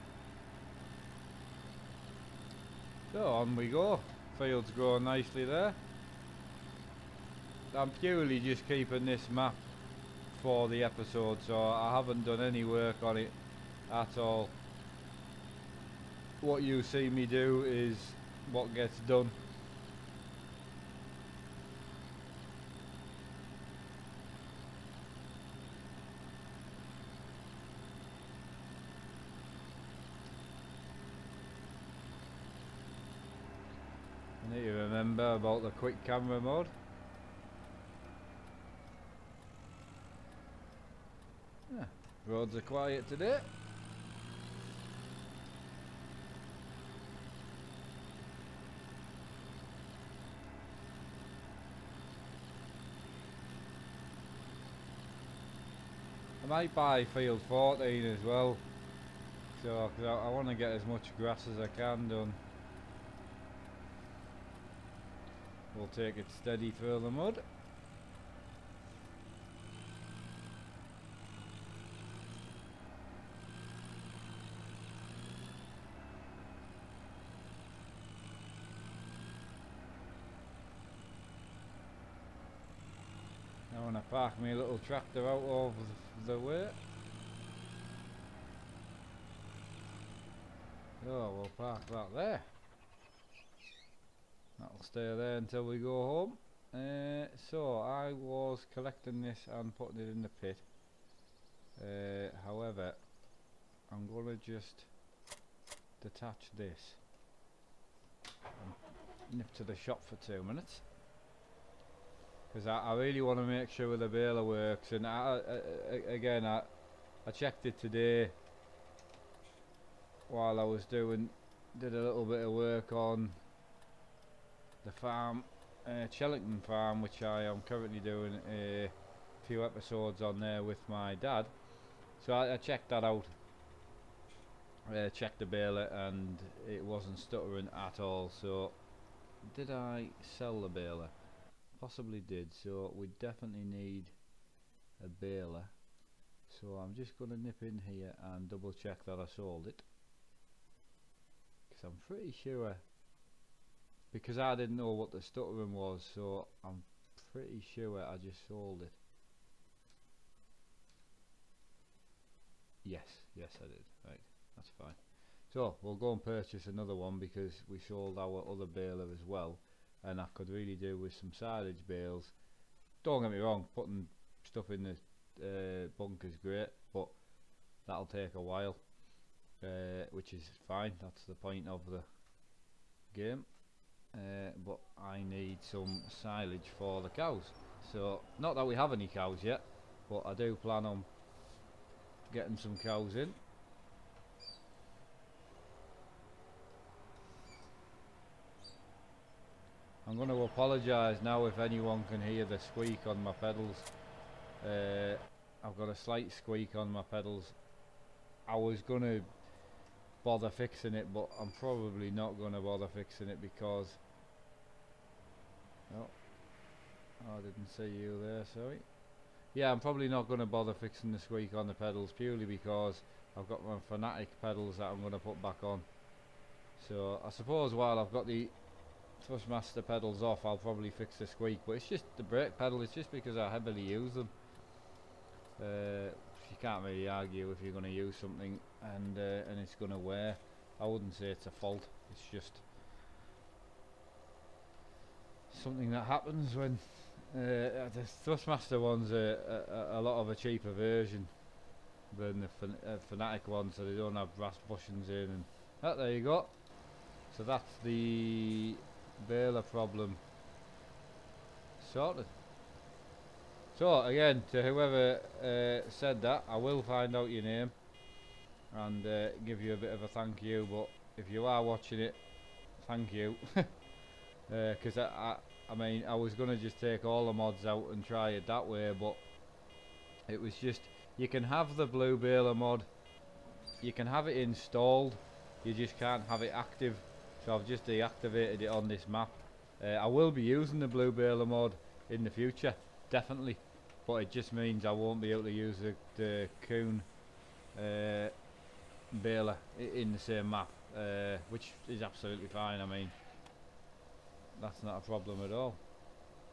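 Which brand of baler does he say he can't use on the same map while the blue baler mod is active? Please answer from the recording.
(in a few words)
Kuhn.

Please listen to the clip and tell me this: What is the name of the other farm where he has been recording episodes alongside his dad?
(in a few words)
Chellington farm.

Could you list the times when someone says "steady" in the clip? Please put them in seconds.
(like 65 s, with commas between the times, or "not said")
66 s.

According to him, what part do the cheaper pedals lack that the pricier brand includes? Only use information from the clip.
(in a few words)
brass bushings.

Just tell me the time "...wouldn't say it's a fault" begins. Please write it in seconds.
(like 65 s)
240 s.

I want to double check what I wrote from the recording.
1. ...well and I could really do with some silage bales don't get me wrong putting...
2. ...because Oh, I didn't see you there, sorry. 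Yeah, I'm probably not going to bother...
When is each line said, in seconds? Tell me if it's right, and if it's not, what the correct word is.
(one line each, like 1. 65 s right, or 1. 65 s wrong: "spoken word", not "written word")
1. 169 s right
2. 213 s right.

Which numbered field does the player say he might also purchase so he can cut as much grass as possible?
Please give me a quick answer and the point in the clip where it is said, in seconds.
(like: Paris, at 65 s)
14, at 57 s.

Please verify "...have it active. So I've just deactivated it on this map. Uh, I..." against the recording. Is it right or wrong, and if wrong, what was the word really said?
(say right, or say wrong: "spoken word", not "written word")
right.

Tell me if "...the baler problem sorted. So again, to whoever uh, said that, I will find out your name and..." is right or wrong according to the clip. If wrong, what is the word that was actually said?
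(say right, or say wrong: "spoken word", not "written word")
right.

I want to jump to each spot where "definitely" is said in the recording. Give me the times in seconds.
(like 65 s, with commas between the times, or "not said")
143 s, 293 s.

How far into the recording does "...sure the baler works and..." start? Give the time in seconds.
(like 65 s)
113 s.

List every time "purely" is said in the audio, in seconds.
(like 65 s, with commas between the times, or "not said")
8 s, 222 s.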